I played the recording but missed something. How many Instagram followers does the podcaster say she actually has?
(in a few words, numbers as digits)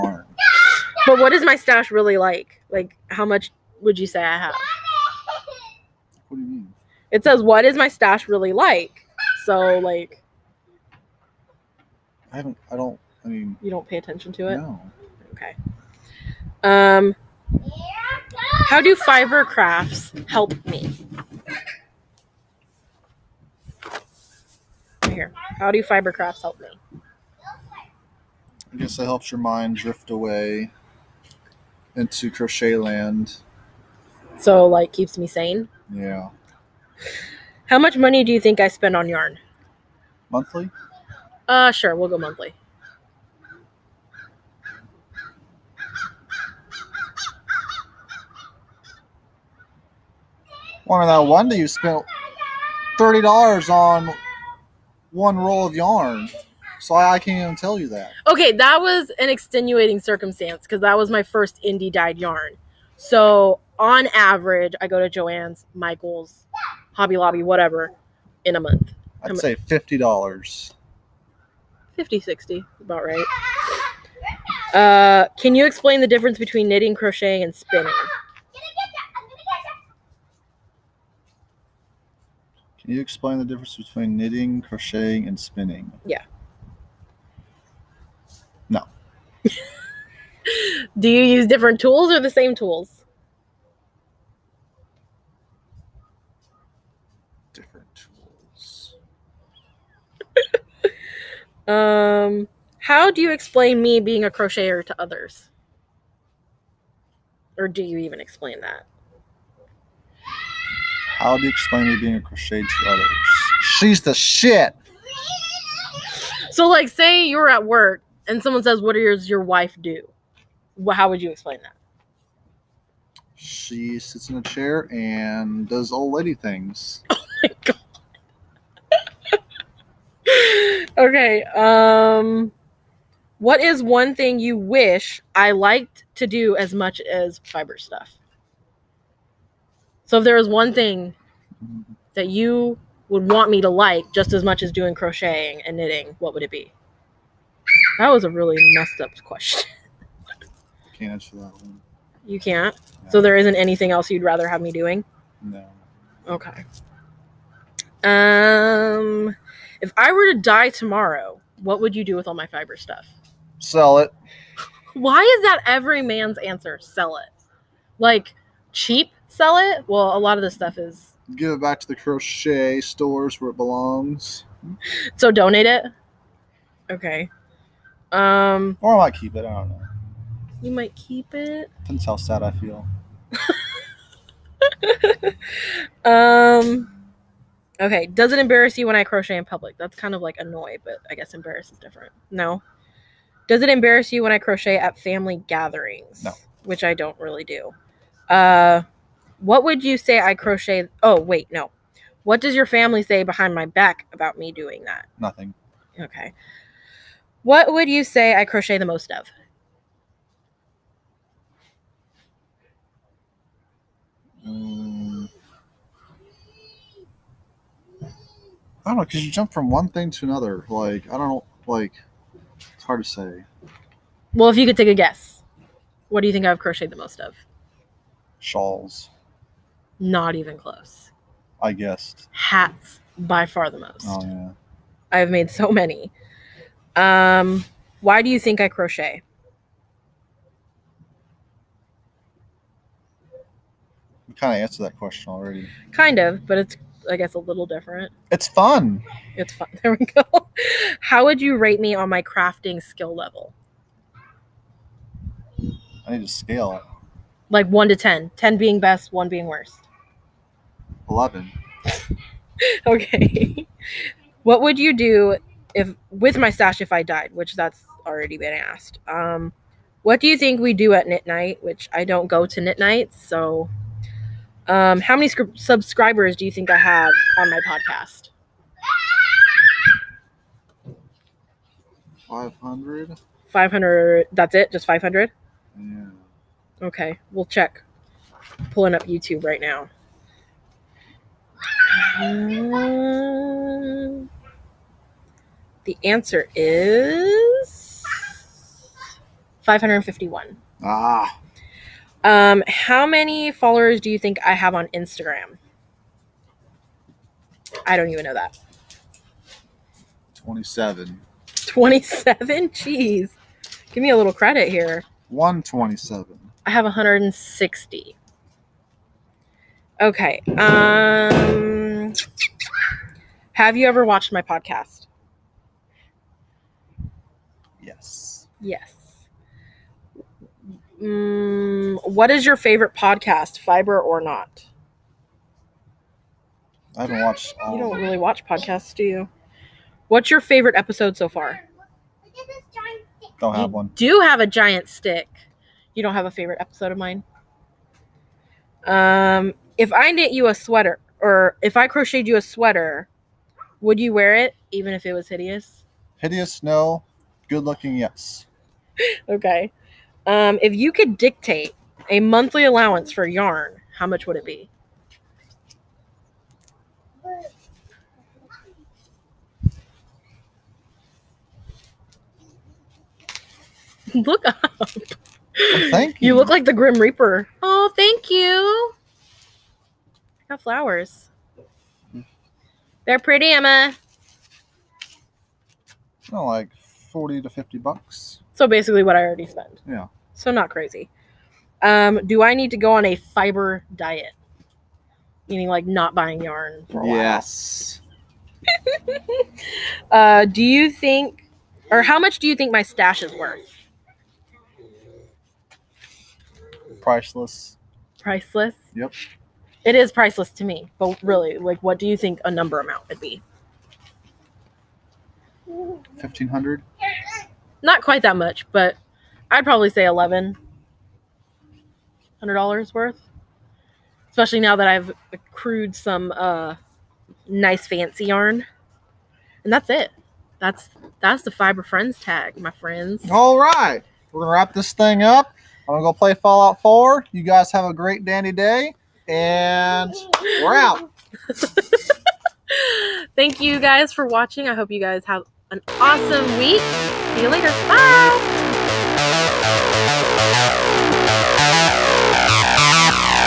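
160.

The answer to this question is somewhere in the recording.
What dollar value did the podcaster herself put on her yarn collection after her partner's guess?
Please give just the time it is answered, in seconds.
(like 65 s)
420 s.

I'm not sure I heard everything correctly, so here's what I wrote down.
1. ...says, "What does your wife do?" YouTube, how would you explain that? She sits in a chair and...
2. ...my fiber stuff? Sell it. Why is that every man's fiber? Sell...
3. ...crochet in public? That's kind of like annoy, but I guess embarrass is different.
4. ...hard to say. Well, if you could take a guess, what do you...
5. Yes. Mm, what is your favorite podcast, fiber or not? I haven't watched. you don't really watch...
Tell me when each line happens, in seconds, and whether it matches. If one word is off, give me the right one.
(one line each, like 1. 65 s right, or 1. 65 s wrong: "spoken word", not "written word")
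1. 118 s wrong: "Well", not "YouTube"
2. 162 s wrong: "answer", not "fiber"
3. 189 s right
4. 222 s right
5. 328 s right.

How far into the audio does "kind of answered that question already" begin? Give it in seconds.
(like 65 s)
244 s.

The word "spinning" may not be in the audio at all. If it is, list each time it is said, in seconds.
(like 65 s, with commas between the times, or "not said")
77 s, 85 s.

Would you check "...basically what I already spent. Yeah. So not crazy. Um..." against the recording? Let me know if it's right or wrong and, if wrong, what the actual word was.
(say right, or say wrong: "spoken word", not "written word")
right.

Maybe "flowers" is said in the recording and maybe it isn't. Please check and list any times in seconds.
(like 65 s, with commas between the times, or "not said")
380 s.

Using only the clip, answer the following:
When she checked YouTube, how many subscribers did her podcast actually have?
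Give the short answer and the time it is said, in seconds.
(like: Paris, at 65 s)
551, at 299 s.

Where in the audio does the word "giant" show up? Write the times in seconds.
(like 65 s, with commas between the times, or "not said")
344 s.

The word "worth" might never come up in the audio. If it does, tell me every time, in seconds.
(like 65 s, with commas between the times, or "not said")
403 s, 422 s.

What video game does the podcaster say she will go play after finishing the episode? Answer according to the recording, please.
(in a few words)
Fallout 4.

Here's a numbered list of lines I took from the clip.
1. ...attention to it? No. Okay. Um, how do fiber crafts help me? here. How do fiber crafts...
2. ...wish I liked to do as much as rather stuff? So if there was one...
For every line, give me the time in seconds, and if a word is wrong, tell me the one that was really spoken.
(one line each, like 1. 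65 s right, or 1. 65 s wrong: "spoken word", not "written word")
1. 13 s right
2. 134 s wrong: "fiber", not "rather".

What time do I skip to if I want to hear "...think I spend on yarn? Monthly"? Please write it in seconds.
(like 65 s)
38 s.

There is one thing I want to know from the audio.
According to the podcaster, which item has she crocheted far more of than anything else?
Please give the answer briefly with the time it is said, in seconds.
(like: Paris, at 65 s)
Hats, at 232 s.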